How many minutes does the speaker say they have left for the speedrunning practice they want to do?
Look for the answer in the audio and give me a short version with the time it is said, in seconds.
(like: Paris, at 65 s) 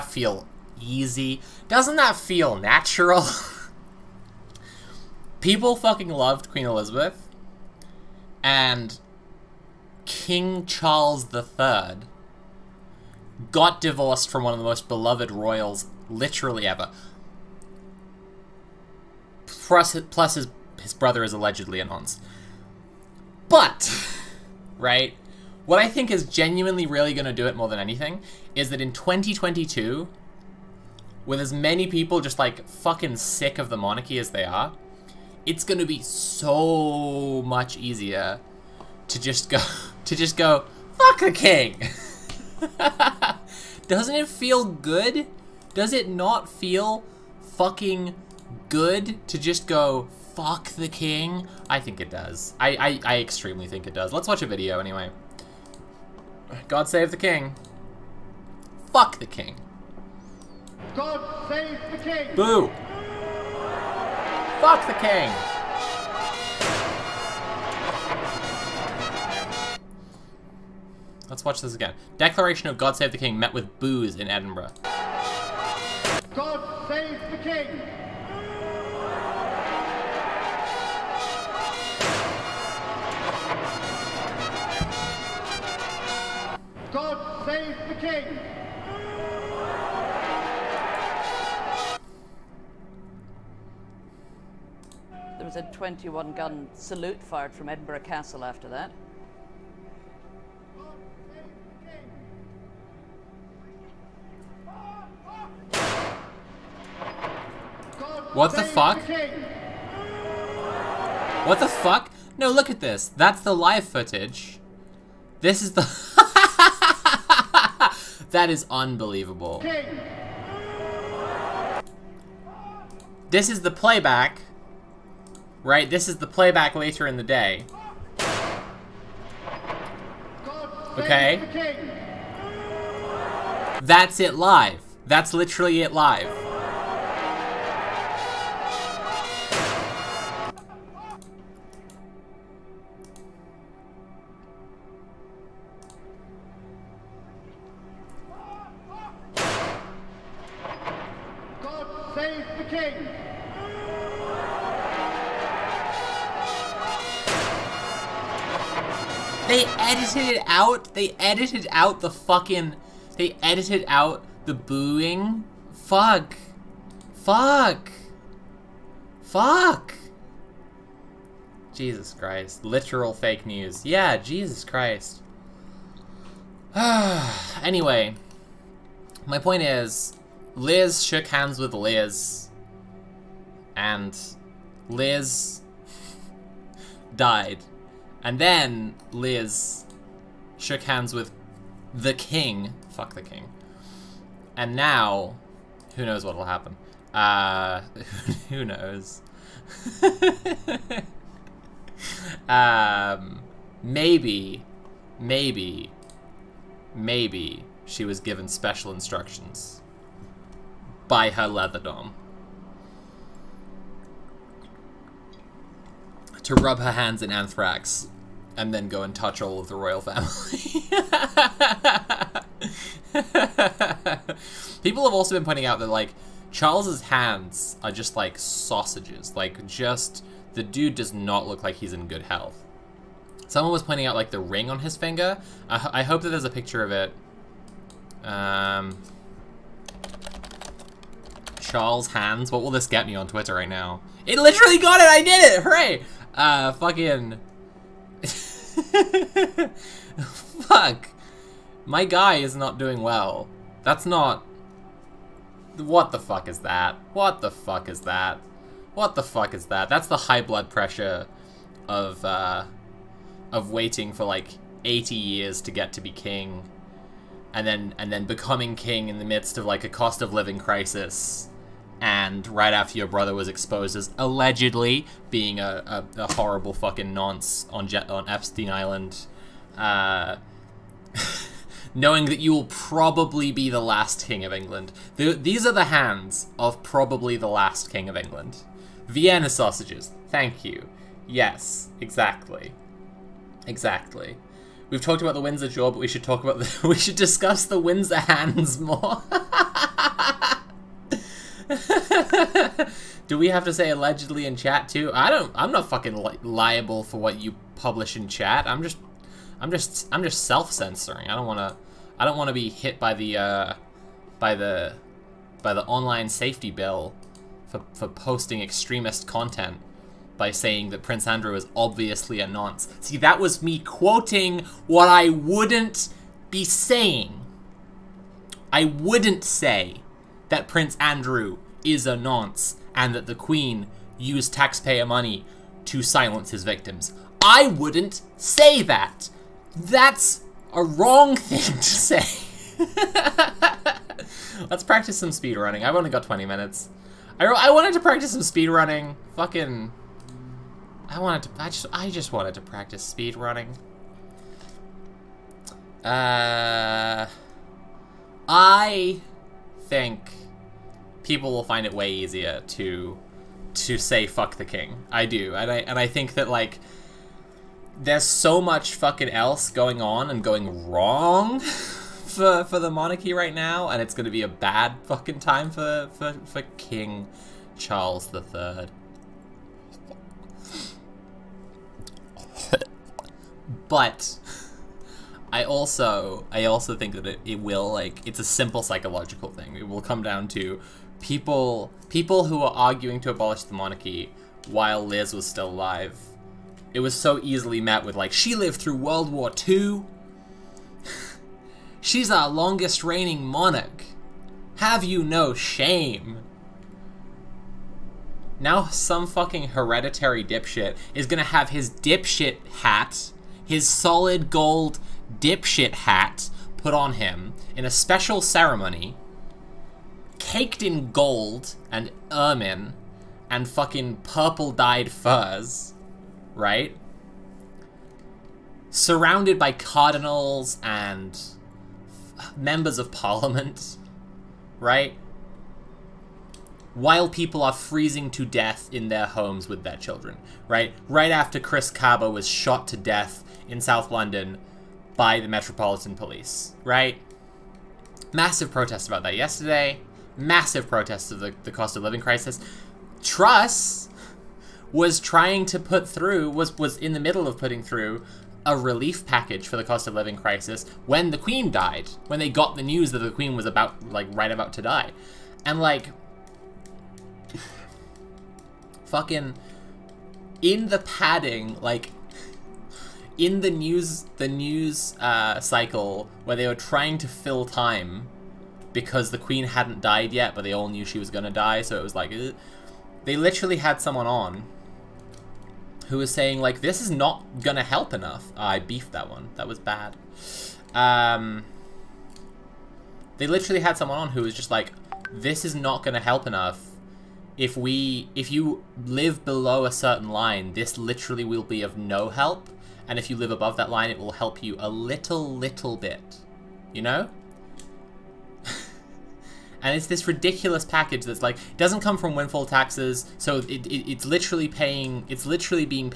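20, at 346 s.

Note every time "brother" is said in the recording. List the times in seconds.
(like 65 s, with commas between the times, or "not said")
20 s, 273 s.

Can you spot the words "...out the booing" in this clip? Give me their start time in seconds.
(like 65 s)
163 s.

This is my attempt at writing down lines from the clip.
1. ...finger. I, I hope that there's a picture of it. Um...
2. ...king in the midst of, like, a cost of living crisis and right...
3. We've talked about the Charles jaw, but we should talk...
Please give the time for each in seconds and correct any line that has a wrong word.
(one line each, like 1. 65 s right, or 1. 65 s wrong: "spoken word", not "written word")
1. 234 s right
2. 268 s right
3. 294 s wrong: "Windsor", not "Charles".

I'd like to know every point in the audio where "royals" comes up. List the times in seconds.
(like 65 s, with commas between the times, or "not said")
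15 s, 219 s.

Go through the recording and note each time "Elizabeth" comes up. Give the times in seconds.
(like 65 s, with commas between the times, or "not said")
6 s.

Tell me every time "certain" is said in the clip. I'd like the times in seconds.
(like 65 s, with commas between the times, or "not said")
499 s.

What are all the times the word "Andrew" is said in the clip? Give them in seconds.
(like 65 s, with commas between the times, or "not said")
321 s, 330 s.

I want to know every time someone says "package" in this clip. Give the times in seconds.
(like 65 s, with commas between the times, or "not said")
459 s, 510 s.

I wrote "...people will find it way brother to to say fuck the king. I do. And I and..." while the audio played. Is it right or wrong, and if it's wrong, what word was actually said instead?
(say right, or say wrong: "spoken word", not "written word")
wrong: "easier", not "brother".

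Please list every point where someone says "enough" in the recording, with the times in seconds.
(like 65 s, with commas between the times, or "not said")
488 s, 496 s.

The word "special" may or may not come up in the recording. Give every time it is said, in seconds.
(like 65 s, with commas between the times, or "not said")
208 s, 417 s.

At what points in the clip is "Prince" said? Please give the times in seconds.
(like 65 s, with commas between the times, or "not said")
321 s, 330 s.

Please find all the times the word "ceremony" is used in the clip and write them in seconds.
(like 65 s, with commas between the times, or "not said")
418 s.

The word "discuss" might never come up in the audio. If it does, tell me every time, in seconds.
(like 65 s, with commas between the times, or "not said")
297 s.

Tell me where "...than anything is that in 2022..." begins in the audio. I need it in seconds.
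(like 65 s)
27 s.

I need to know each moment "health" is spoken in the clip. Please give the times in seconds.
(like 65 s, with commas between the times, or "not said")
232 s.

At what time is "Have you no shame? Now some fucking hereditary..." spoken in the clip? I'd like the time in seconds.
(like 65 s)
404 s.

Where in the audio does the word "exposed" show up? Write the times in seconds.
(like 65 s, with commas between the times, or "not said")
273 s.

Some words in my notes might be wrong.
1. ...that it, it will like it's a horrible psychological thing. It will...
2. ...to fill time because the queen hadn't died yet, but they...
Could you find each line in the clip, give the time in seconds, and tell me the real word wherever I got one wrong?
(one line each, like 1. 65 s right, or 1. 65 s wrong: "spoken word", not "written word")
1. 387 s wrong: "simple", not "horrible"
2. 477 s right.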